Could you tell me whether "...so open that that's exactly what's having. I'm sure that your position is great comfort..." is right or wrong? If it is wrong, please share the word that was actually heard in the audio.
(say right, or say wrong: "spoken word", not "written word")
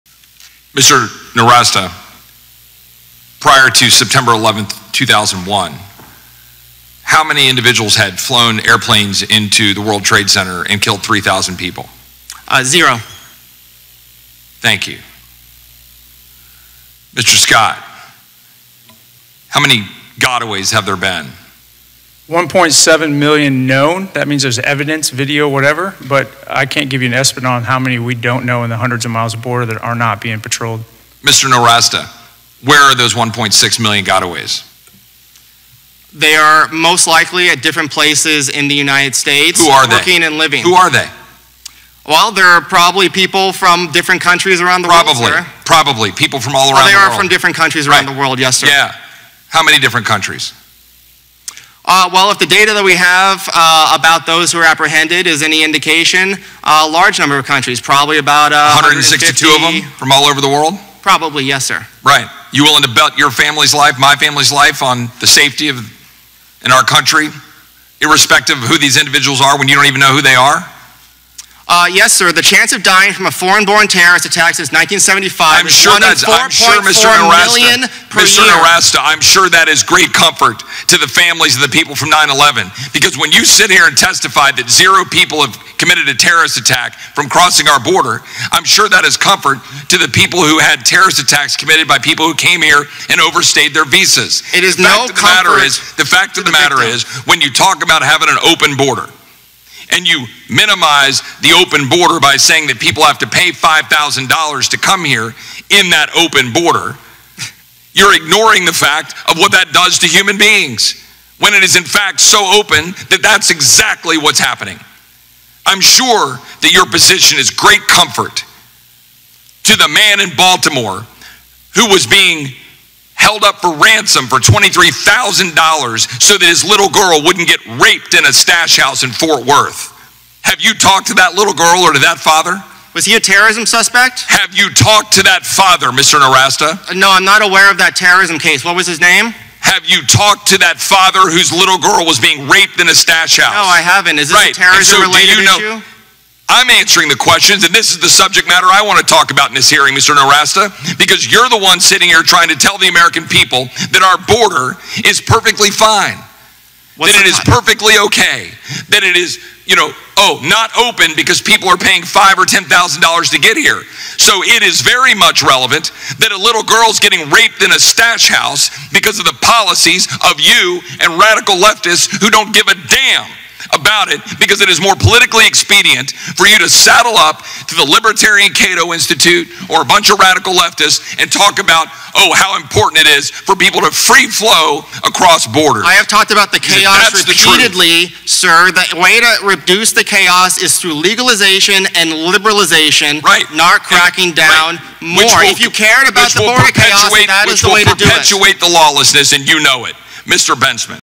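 wrong: "happening", not "having".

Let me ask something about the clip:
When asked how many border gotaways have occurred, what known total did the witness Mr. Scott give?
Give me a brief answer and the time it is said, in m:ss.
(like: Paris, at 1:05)
1.7 million, at 0:22.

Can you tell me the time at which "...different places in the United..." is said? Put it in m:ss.
0:37.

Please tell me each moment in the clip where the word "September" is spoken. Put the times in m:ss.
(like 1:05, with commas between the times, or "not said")
0:03.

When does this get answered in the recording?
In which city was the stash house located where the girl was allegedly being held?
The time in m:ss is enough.
2:09.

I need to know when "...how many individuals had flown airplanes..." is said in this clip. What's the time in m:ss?
0:07.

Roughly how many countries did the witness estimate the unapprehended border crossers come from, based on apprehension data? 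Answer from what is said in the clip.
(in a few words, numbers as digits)
162.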